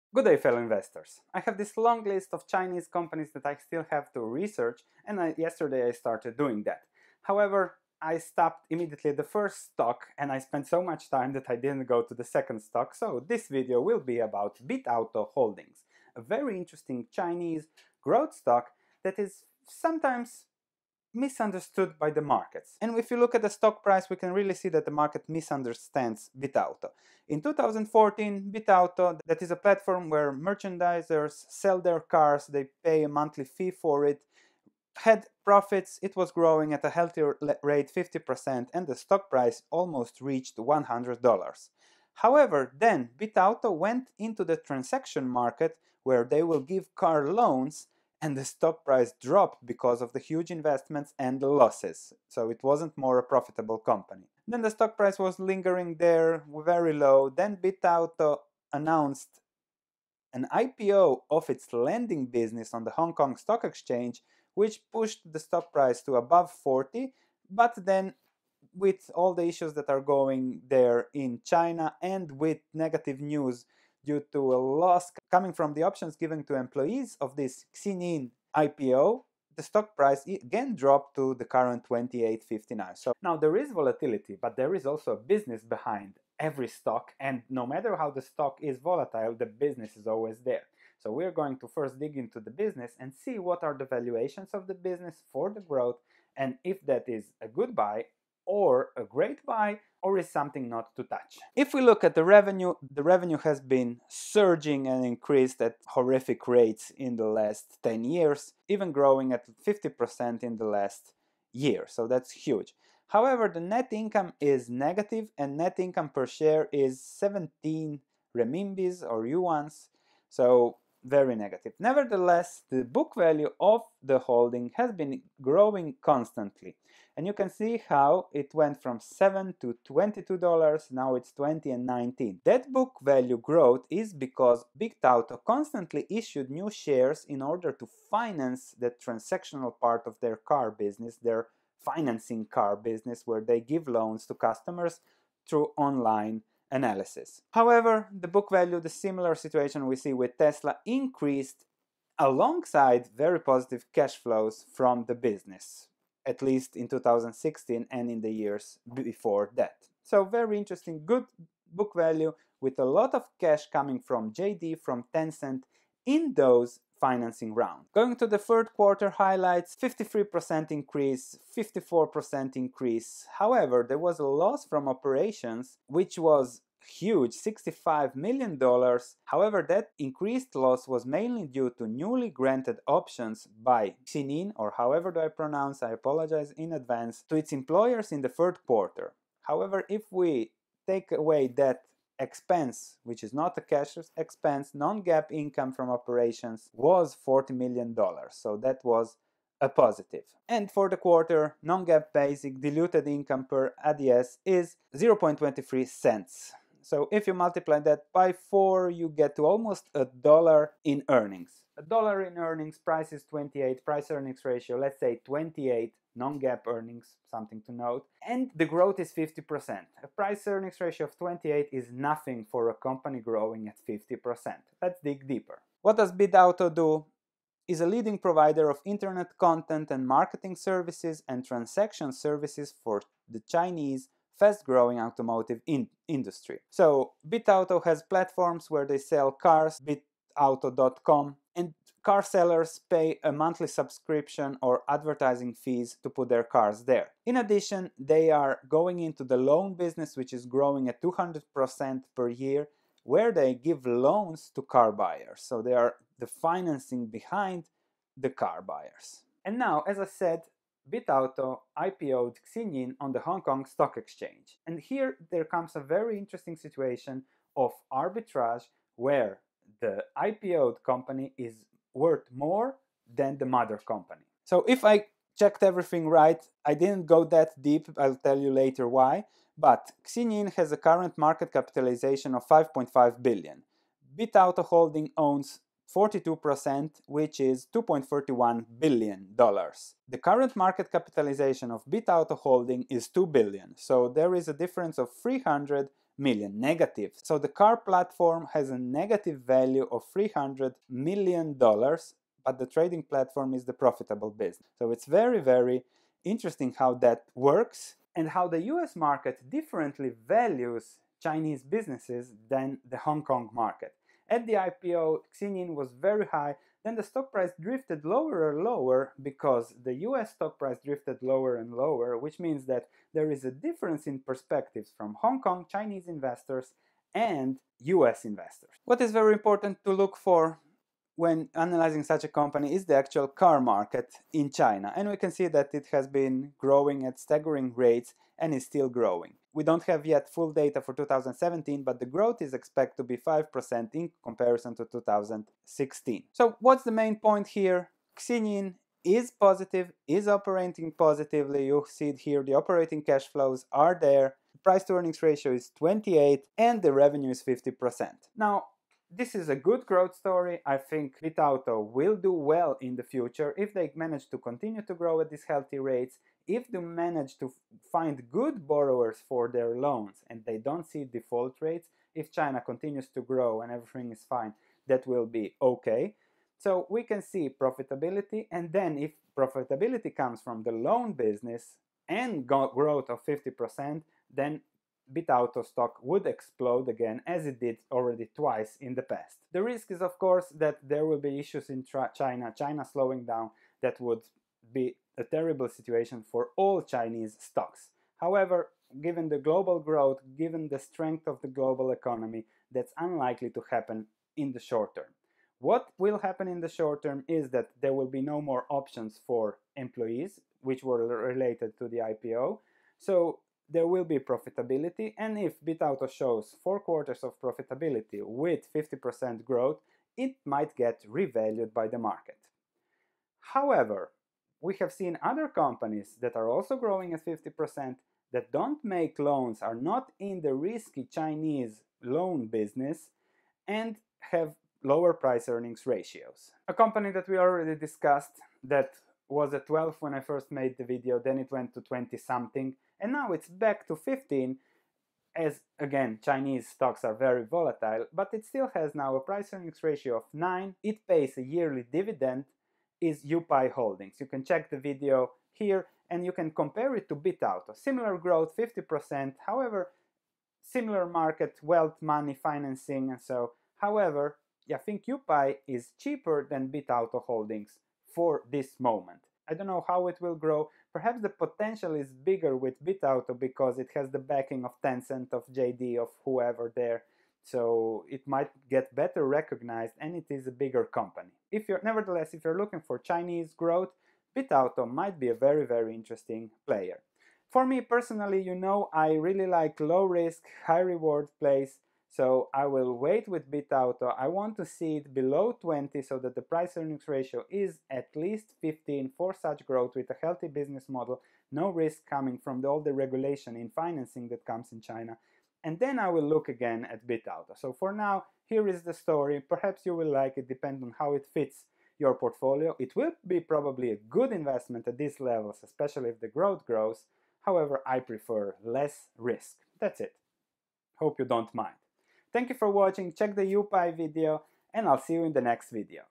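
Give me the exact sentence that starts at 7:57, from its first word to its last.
So it might get better recognized and it is a bigger company.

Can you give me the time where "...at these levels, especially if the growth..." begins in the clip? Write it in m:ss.
8:34.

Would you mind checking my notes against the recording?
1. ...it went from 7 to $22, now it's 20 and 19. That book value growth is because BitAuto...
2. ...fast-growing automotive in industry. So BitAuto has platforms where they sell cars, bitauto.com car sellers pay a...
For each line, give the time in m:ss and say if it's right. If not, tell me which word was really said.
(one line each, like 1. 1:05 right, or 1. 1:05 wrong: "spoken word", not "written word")
1. 2:08 right
2. 3:54 right.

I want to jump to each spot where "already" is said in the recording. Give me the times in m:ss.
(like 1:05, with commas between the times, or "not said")
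6:27, 7:17.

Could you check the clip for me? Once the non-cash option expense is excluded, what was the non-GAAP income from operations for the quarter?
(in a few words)
$40 million.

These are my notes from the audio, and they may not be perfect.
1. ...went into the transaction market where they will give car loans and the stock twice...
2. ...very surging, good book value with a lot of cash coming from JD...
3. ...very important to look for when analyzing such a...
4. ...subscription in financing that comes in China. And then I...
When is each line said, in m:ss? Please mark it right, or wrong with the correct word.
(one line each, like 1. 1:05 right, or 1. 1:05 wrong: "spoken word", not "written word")
1. 0:43 wrong: "price", not "twice"
2. 2:40 wrong: "interesting", not "surging"
3. 5:29 right
4. 8:22 wrong: "regulation", not "subscription".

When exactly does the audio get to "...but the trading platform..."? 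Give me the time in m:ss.
5:02.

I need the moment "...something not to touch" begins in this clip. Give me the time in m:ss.
1:40.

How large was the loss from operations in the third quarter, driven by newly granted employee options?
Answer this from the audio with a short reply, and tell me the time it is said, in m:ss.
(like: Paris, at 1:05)
$65 million, at 2:57.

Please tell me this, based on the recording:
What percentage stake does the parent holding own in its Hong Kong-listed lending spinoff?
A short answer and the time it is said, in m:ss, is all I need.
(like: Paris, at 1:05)
42%, at 4:45.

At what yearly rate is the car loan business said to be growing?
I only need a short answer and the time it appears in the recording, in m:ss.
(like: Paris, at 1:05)
200%, at 4:11.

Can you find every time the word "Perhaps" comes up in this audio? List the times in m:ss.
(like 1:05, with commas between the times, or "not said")
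7:50, 8:29.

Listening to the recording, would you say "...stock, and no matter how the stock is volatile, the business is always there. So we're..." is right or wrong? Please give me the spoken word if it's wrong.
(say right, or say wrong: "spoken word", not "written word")
right.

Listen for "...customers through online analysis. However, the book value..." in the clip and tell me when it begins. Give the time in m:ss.
2:24.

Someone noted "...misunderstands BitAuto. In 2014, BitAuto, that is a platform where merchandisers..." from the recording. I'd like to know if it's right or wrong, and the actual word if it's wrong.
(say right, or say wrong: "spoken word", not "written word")
right.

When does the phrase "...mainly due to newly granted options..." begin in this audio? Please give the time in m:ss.
3:01.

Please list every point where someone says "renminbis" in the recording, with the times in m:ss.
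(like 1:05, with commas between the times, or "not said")
1:58.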